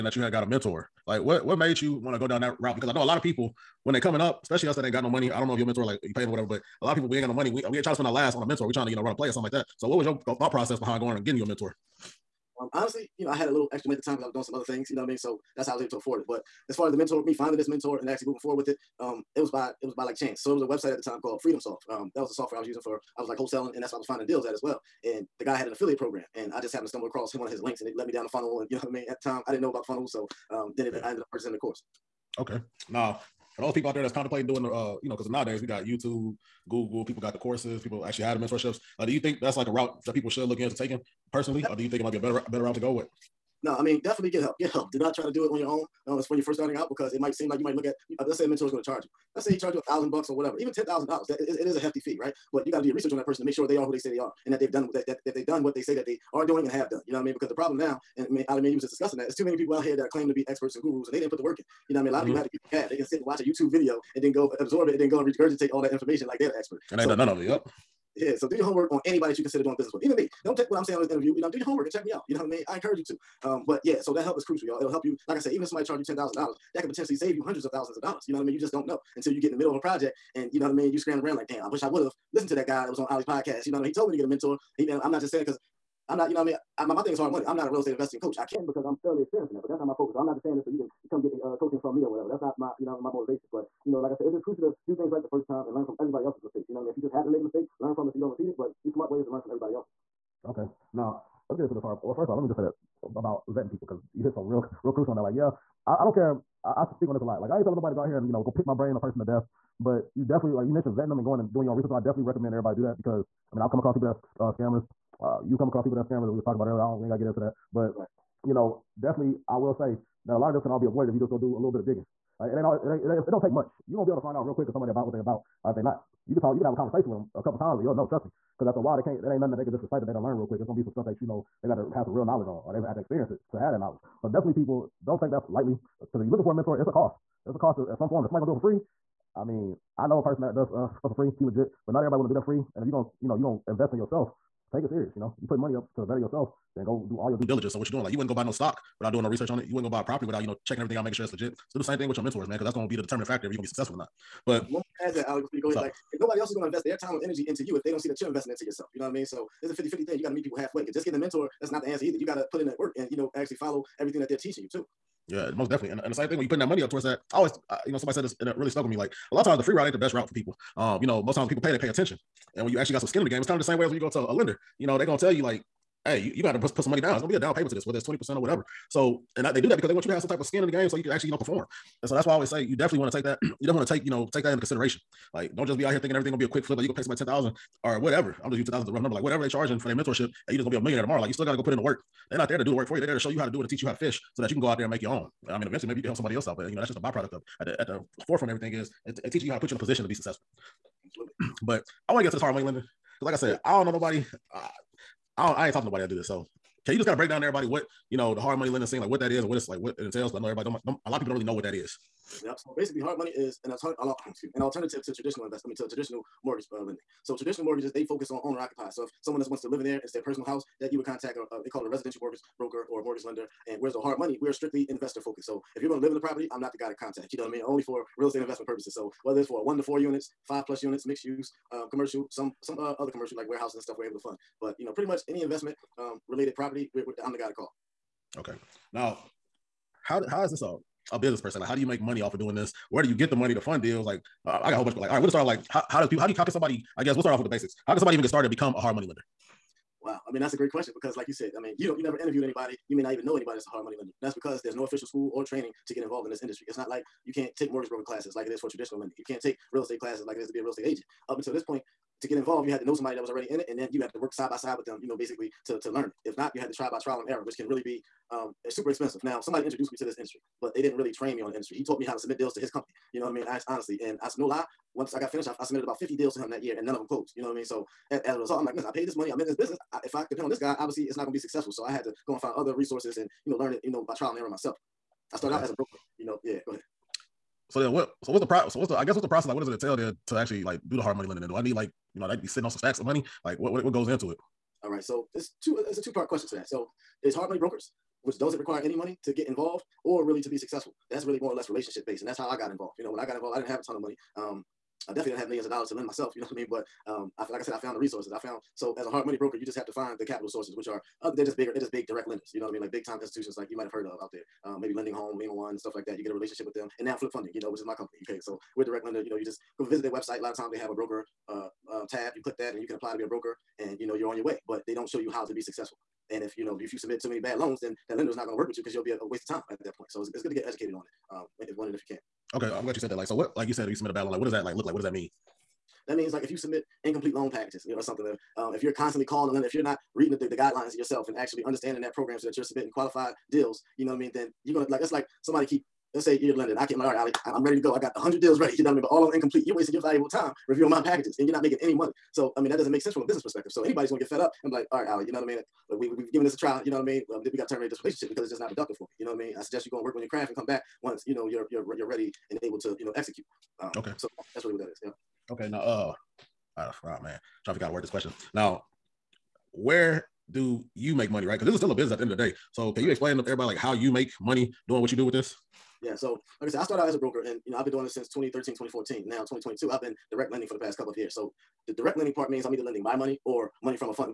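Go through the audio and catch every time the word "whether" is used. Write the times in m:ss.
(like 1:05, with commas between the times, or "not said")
2:57, 3:49.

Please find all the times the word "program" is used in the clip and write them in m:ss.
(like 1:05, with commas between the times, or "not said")
0:25, 5:42.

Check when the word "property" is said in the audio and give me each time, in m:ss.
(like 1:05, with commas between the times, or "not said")
2:30, 3:46, 3:56.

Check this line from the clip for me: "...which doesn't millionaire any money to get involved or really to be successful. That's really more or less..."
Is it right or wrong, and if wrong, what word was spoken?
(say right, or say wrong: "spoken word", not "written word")
wrong: "require", not "millionaire".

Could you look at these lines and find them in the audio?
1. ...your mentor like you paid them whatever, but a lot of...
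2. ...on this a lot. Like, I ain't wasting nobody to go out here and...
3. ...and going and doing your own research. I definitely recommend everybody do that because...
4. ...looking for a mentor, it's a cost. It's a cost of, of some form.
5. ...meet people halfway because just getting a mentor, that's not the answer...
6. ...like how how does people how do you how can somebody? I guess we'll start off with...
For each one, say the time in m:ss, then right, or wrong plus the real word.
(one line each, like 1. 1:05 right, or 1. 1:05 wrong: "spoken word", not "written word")
1. 0:05 right
2. 1:47 wrong: "telling", not "wasting"
3. 1:51 right
4. 2:16 right
5. 2:40 right
6. 4:05 right.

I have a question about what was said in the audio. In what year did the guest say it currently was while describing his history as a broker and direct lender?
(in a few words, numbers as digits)
2022.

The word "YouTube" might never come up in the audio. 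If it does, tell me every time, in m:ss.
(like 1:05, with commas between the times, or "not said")
0:35, 1:03.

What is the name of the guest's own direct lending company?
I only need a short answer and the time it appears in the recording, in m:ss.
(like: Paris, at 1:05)
Flip Funding, at 5:17.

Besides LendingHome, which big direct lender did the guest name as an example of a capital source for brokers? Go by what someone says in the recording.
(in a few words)
Lima One.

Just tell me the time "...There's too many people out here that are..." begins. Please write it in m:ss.
0:59.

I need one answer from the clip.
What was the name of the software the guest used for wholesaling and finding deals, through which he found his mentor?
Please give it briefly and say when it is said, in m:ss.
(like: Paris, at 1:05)
FreedomSoft, at 0:21.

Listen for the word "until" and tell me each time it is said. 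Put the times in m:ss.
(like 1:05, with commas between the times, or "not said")
1:19, 4:21.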